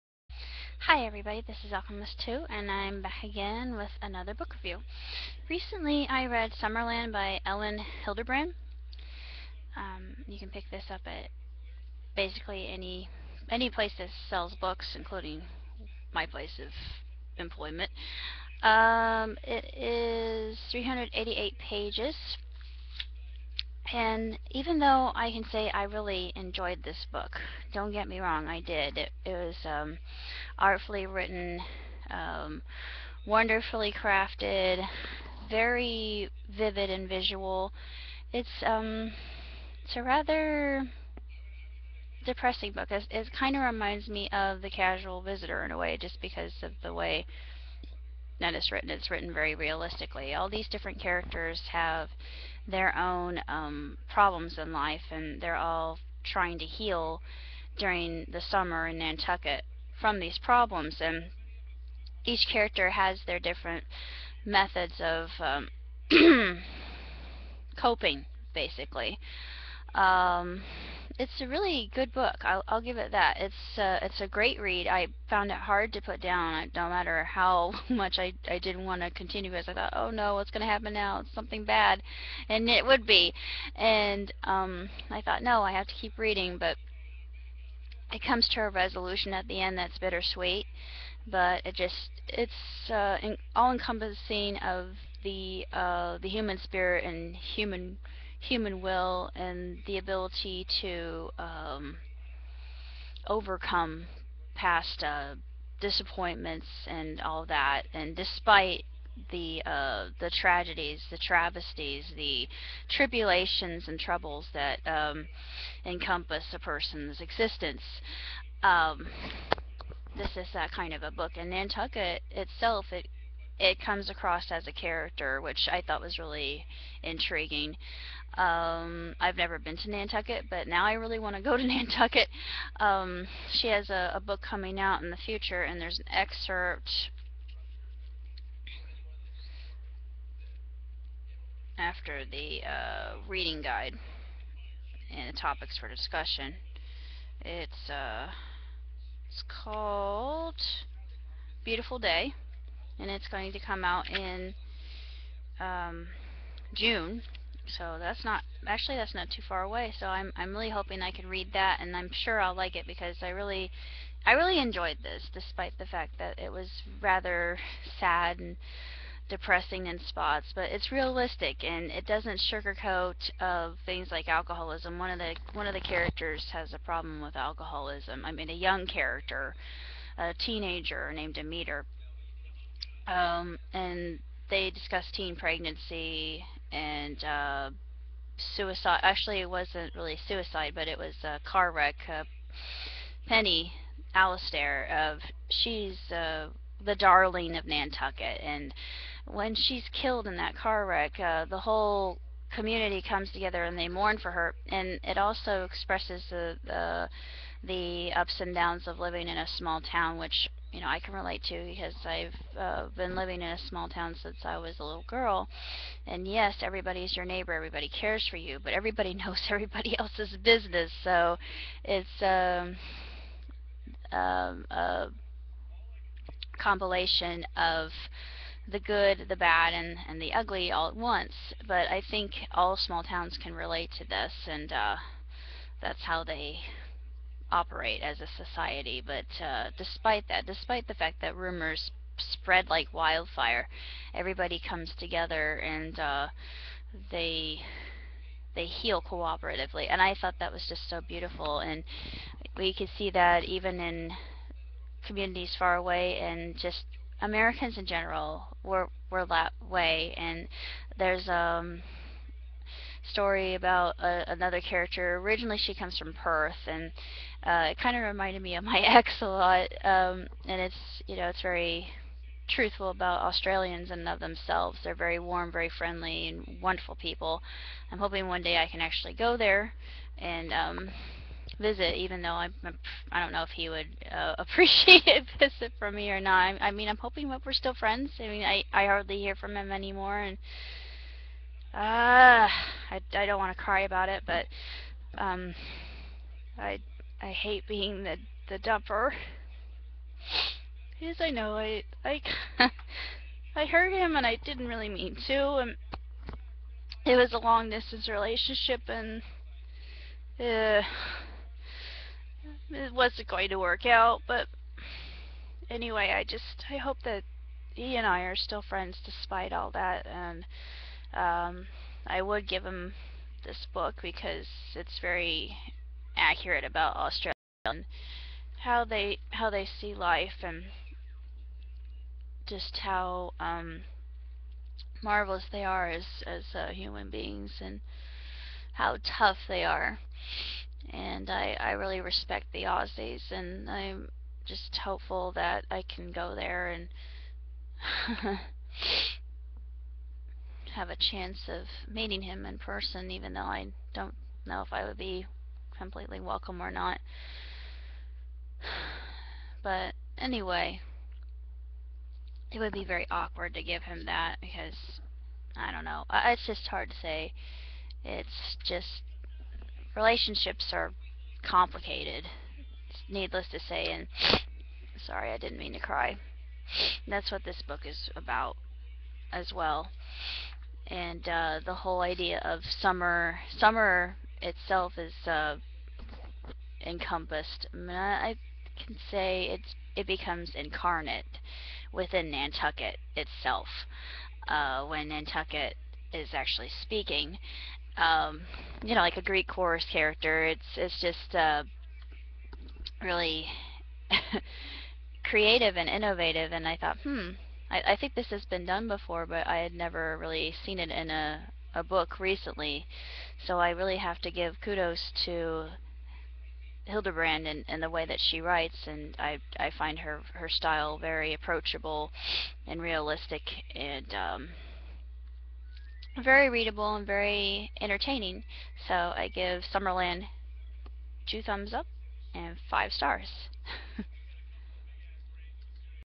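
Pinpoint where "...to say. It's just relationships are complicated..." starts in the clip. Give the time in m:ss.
6:06.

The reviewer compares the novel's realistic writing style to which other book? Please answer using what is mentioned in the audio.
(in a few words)
The Casual Visitor.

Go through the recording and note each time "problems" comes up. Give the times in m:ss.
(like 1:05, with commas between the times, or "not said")
0:54, 1:00, 2:56.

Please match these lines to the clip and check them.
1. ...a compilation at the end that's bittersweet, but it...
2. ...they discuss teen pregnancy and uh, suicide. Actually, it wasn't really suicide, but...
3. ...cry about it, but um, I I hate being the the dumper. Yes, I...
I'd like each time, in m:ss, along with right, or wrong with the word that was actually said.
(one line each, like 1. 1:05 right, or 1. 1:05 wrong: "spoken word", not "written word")
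1. 1:28 wrong: "resolution", not "compilation"
2. 3:04 right
3. 4:53 right.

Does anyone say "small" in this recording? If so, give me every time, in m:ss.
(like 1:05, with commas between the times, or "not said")
3:29, 3:33, 3:52.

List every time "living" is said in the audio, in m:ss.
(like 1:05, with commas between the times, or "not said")
3:28, 3:33.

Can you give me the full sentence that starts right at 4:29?
Um, and it's you know it's very truthful about Australians and of themselves.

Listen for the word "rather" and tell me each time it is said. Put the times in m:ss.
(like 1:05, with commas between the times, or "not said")
0:40, 2:47.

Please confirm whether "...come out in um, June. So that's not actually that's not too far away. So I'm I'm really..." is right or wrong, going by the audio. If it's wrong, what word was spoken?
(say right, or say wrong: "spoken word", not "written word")
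right.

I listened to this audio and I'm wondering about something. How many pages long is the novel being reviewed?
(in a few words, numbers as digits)
388.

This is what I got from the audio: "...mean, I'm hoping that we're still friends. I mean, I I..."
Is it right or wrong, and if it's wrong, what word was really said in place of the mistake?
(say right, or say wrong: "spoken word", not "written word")
right.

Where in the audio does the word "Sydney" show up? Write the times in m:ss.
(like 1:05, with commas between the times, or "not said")
not said.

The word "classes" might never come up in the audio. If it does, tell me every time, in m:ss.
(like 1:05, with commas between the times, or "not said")
not said.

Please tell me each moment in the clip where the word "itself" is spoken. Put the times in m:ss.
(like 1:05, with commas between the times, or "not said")
2:02, 6:24, 6:33.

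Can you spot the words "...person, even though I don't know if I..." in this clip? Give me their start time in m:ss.
5:52.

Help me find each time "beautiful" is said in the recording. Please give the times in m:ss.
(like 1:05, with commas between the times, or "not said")
2:31, 4:11.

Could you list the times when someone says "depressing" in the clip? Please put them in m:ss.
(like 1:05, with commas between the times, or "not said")
0:42, 2:49.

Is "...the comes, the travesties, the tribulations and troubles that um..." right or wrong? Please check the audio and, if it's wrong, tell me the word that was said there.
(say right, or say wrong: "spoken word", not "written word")
wrong: "tragedies", not "comes".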